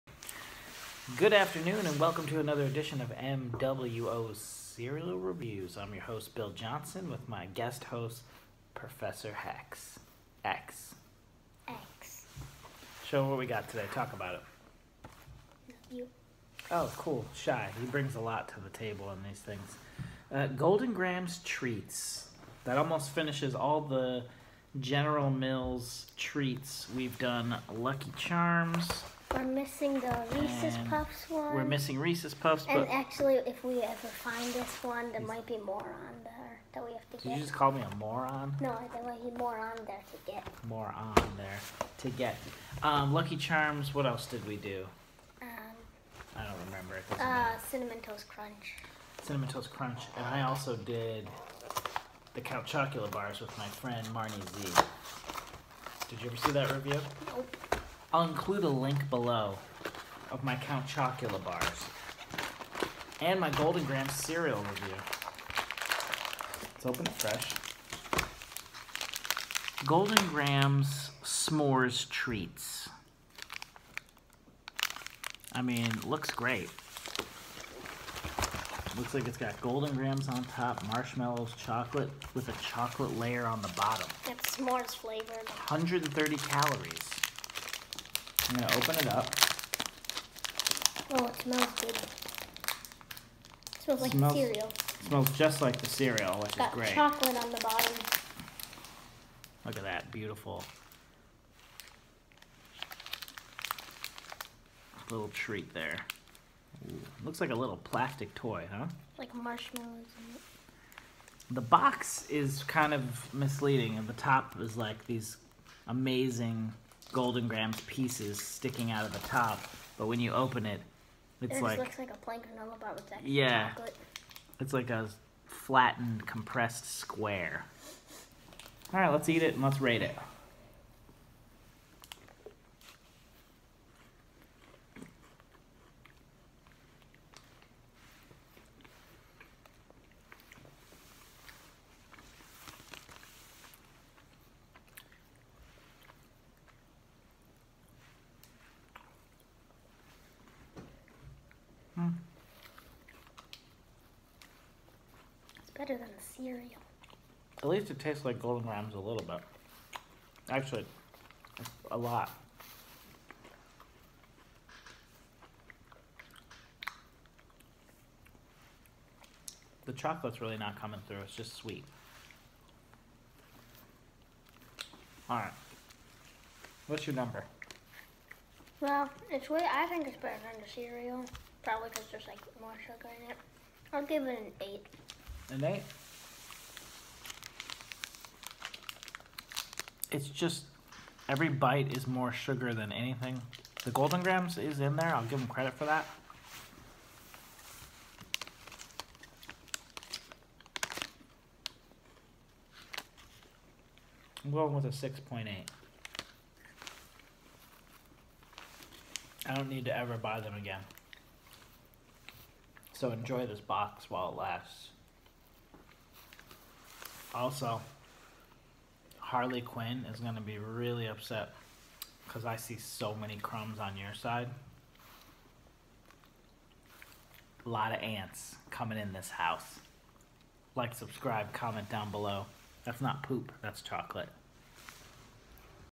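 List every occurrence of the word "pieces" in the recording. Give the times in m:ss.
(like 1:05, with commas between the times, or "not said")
1:57.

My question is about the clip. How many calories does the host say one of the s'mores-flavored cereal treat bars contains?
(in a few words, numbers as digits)
130.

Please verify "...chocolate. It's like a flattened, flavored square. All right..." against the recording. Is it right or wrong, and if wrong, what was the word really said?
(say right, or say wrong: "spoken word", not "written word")
wrong: "compressed", not "flavored".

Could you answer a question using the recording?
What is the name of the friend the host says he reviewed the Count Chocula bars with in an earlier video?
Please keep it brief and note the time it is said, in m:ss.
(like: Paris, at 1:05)
Marnie Z, at 0:54.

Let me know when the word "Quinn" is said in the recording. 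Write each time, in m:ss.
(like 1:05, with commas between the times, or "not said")
3:39.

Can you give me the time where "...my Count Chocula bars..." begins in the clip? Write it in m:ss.
1:00.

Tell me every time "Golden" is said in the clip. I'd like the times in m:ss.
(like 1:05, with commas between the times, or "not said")
0:20, 1:03, 1:09, 1:19, 1:57, 2:38, 3:13.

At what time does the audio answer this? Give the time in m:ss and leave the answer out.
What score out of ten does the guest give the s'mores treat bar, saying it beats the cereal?
3:03.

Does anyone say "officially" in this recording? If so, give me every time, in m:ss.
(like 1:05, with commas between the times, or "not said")
not said.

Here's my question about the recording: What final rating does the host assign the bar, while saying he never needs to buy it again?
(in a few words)
6.8.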